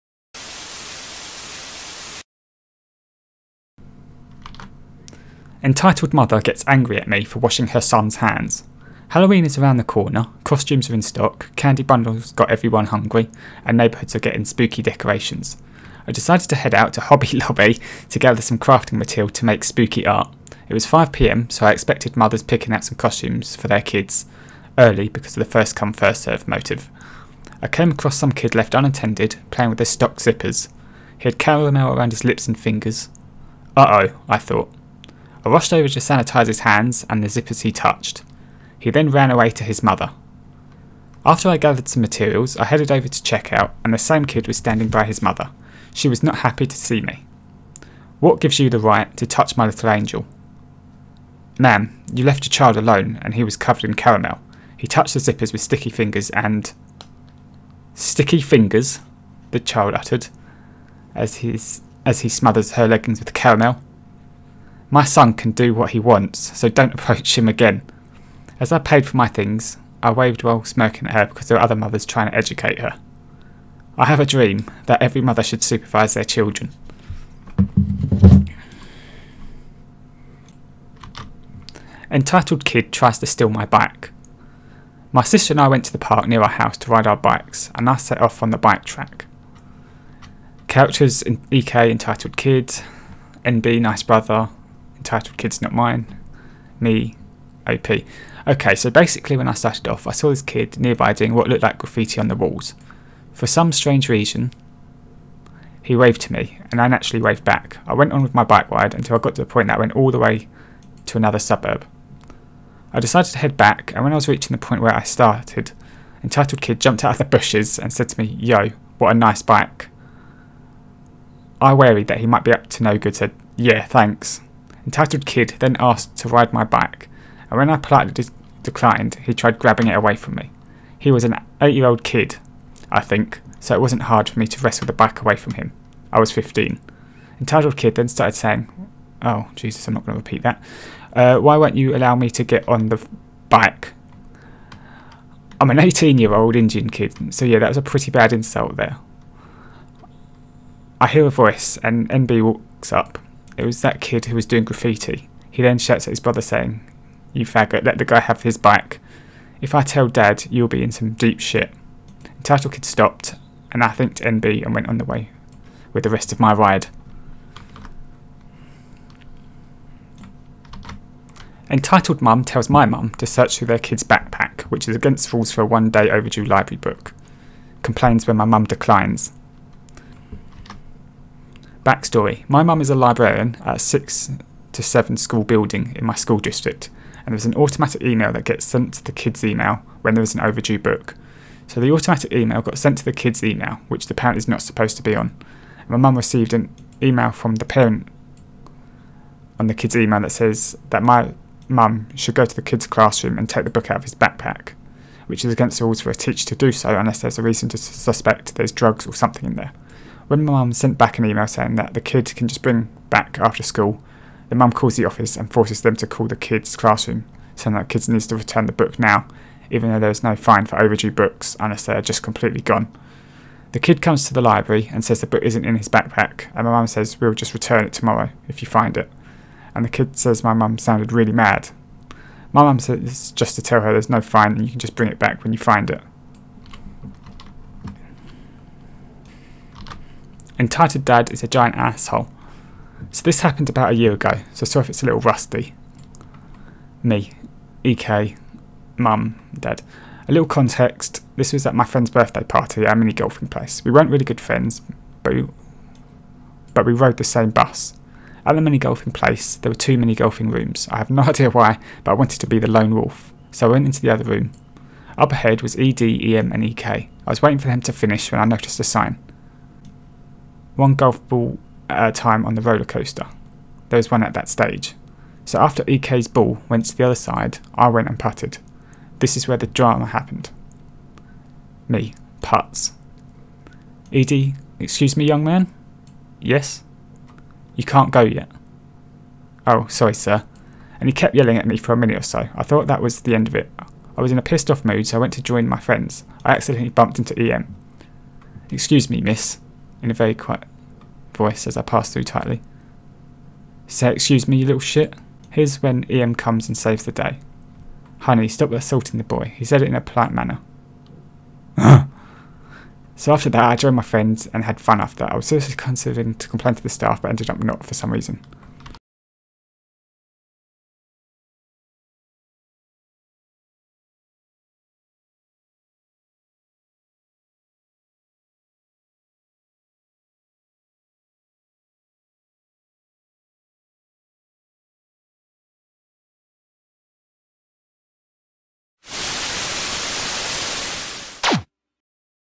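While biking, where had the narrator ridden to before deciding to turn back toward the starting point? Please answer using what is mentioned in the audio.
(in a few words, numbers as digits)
another suburb.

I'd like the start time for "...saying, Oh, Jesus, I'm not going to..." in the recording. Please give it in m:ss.
2:18.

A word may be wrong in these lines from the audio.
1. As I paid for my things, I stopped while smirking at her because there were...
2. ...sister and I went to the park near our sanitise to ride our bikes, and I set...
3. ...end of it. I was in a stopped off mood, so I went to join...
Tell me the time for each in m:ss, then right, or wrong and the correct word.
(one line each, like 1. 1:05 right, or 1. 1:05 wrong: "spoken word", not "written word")
1. 1:08 wrong: "waved", not "stopped"
2. 1:25 wrong: "house", not "sanitise"
3. 4:53 wrong: "pissed", not "stopped".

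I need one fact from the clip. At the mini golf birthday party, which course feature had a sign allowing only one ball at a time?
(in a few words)
roller coaster.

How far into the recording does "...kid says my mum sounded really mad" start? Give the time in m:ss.
3:49.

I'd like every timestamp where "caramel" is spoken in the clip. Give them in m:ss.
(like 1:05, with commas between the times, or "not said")
0:31, 0:53, 1:03.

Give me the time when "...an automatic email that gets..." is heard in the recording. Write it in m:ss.
3:07.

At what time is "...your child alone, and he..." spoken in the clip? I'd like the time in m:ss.
0:52.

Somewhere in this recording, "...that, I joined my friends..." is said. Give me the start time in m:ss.
5:13.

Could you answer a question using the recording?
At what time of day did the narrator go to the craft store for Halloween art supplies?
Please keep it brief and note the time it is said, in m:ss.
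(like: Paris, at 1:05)
5pm, at 0:20.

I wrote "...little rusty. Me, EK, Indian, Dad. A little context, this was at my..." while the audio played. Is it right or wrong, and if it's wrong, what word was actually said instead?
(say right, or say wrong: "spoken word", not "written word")
wrong: "Mum", not "Indian".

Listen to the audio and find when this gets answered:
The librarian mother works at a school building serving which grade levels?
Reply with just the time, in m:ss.
3:03.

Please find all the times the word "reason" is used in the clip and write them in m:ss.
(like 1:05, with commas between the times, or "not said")
1:44, 3:27, 5:18.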